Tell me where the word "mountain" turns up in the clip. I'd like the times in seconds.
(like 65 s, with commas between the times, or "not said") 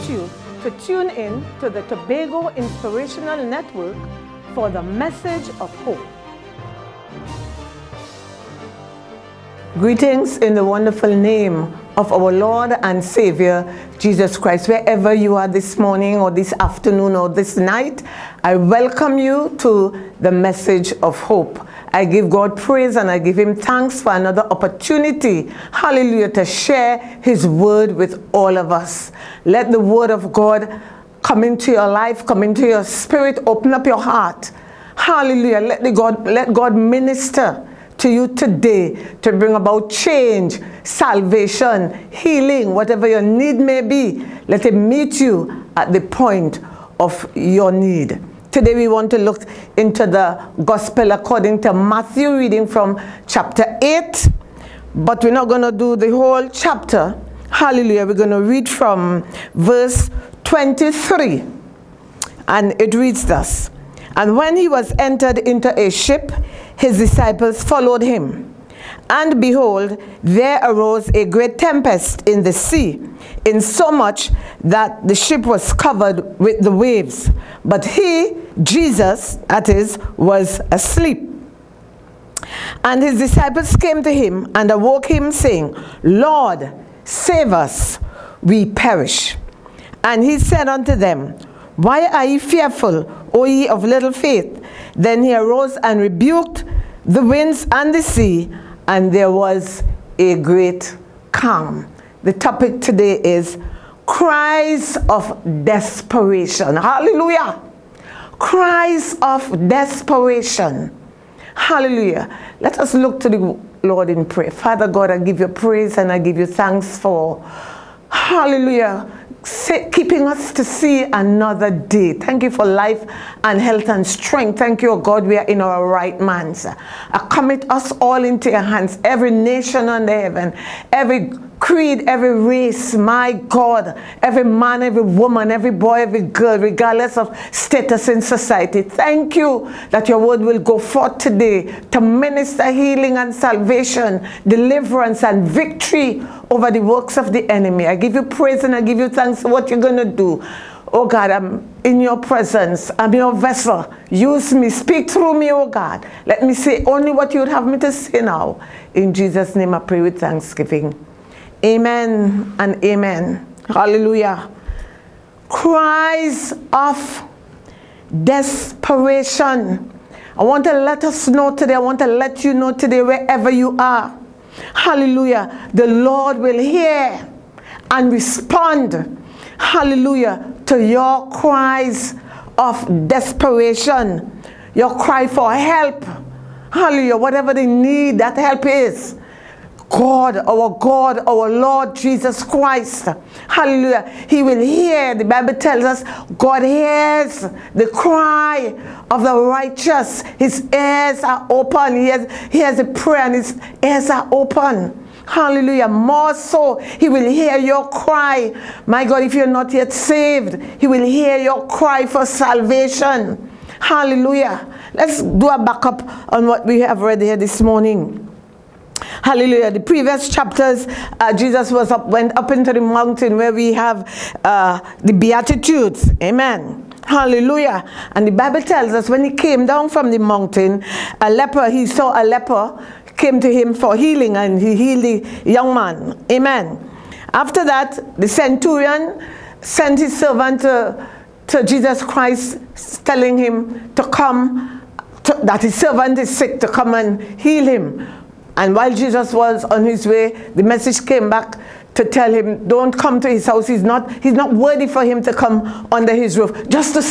222 s, 230 s.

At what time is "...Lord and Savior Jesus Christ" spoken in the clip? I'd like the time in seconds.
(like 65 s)
12 s.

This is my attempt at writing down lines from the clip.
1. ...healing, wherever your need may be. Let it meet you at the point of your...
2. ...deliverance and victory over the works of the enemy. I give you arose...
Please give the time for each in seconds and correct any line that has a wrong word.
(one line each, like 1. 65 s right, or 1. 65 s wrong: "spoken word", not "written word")
1. 42 s wrong: "whatever", not "wherever"
2. 144 s wrong: "praise", not "arose".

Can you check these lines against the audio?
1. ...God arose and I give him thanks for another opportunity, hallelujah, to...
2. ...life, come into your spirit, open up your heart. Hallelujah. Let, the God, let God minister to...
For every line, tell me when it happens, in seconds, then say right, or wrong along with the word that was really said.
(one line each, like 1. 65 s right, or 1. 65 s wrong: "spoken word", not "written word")
1. 22 s wrong: "praise", not "arose"
2. 31 s right.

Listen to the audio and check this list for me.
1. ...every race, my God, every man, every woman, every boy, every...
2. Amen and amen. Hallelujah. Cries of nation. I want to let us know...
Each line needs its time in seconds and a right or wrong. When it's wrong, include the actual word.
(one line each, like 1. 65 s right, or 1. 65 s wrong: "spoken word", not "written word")
1. 132 s right
2. 161 s wrong: "desperation", not "nation".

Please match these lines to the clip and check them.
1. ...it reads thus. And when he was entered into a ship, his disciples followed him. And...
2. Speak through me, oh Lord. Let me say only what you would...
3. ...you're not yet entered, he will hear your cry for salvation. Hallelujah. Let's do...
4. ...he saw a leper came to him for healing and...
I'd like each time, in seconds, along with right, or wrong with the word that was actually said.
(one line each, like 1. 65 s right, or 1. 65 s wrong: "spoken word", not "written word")
1. 62 s right
2. 154 s wrong: "God", not "Lord"
3. 209 s wrong: "saved", not "entered"
4. 231 s right.